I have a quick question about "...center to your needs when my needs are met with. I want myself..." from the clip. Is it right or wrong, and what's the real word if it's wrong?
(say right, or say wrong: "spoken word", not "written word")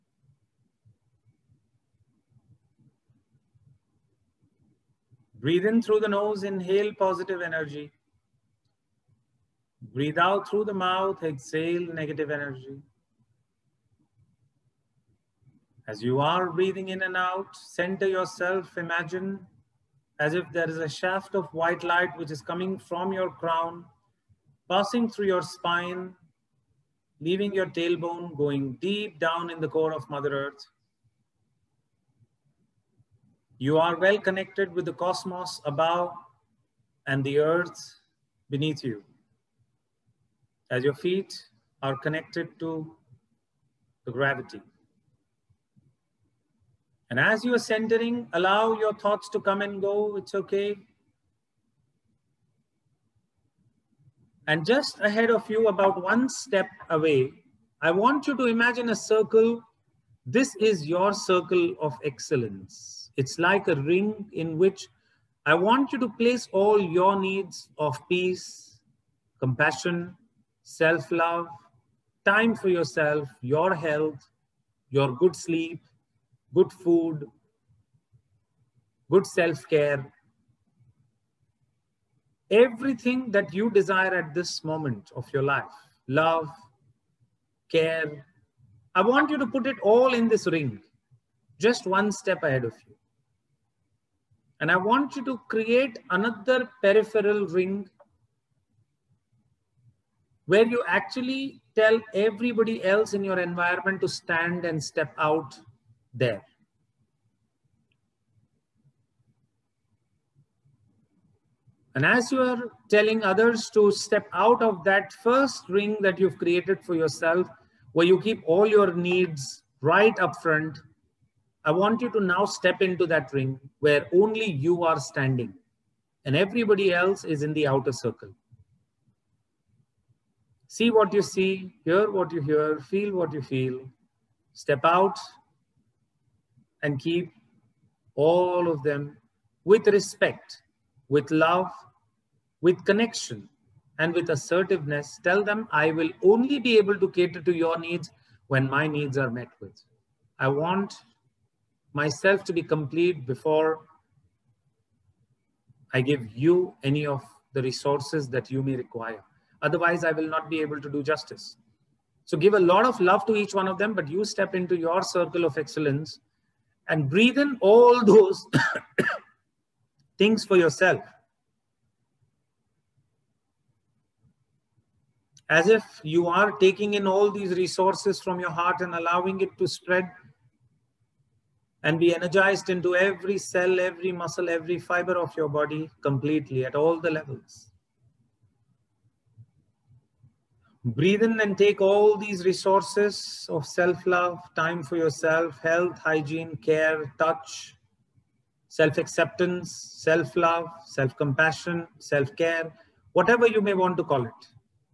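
wrong: "cater", not "center".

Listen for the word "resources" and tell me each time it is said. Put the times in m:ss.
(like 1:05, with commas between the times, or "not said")
2:37, 2:57, 3:12.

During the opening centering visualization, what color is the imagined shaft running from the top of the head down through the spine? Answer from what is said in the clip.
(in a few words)
White.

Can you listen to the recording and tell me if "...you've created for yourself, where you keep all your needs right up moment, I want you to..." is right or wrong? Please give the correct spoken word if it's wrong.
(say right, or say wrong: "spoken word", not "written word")
wrong: "front", not "moment".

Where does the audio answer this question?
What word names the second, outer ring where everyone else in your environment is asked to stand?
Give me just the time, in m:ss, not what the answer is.
1:36.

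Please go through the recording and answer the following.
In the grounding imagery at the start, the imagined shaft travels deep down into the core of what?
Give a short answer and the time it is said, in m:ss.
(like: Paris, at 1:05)
Mother Earth, at 0:30.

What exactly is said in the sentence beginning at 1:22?
Everything that you desire at this moment of your life love, care.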